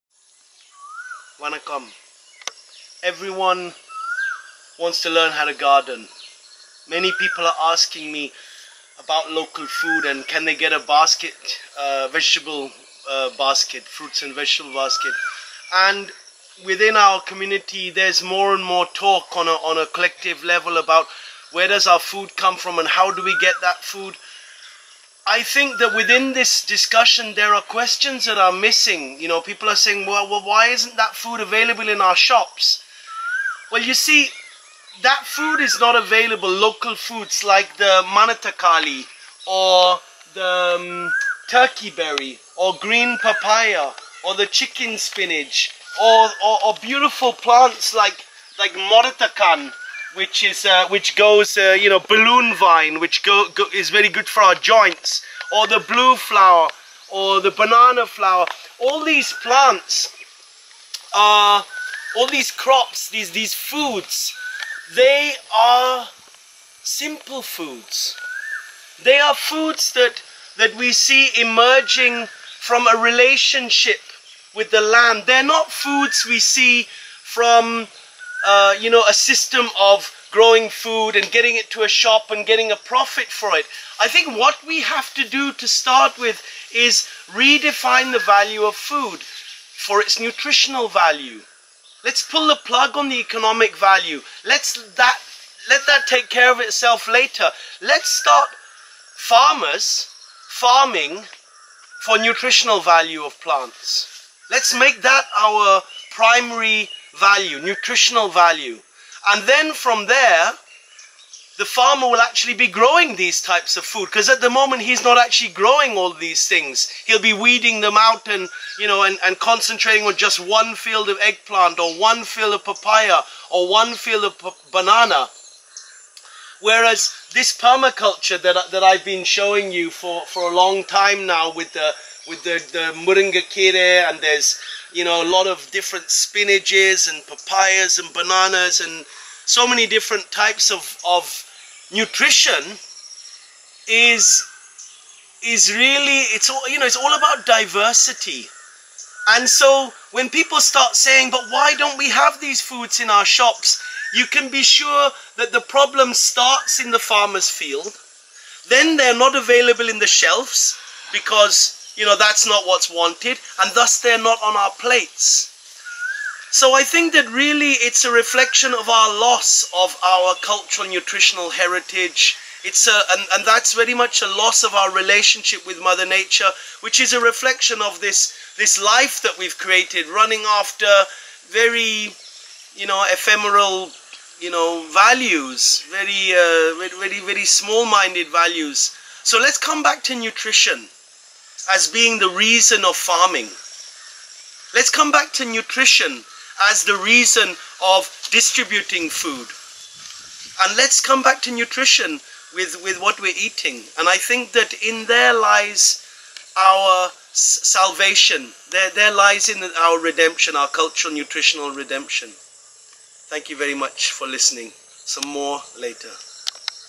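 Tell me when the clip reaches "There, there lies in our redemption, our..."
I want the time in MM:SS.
03:28.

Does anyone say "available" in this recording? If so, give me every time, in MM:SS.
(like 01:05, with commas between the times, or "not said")
00:31, 00:35, 02:39.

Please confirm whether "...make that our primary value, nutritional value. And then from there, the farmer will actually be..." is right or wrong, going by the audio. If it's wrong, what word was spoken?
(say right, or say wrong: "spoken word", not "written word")
right.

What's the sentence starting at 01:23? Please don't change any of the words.
I think what we have to do to start with is redefine the value of food for its nutritional value.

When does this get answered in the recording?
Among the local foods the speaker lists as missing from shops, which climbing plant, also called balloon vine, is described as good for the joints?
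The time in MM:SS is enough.
00:48.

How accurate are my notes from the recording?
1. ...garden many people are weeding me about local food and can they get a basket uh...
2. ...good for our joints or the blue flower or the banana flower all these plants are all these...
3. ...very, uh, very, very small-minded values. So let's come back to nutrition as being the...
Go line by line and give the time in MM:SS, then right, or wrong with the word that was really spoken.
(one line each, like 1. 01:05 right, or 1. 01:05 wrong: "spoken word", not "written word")
1. 00:05 wrong: "asking", not "weeding"
2. 00:54 right
3. 03:05 right.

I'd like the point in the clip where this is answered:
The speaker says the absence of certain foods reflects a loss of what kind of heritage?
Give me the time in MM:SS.
02:50.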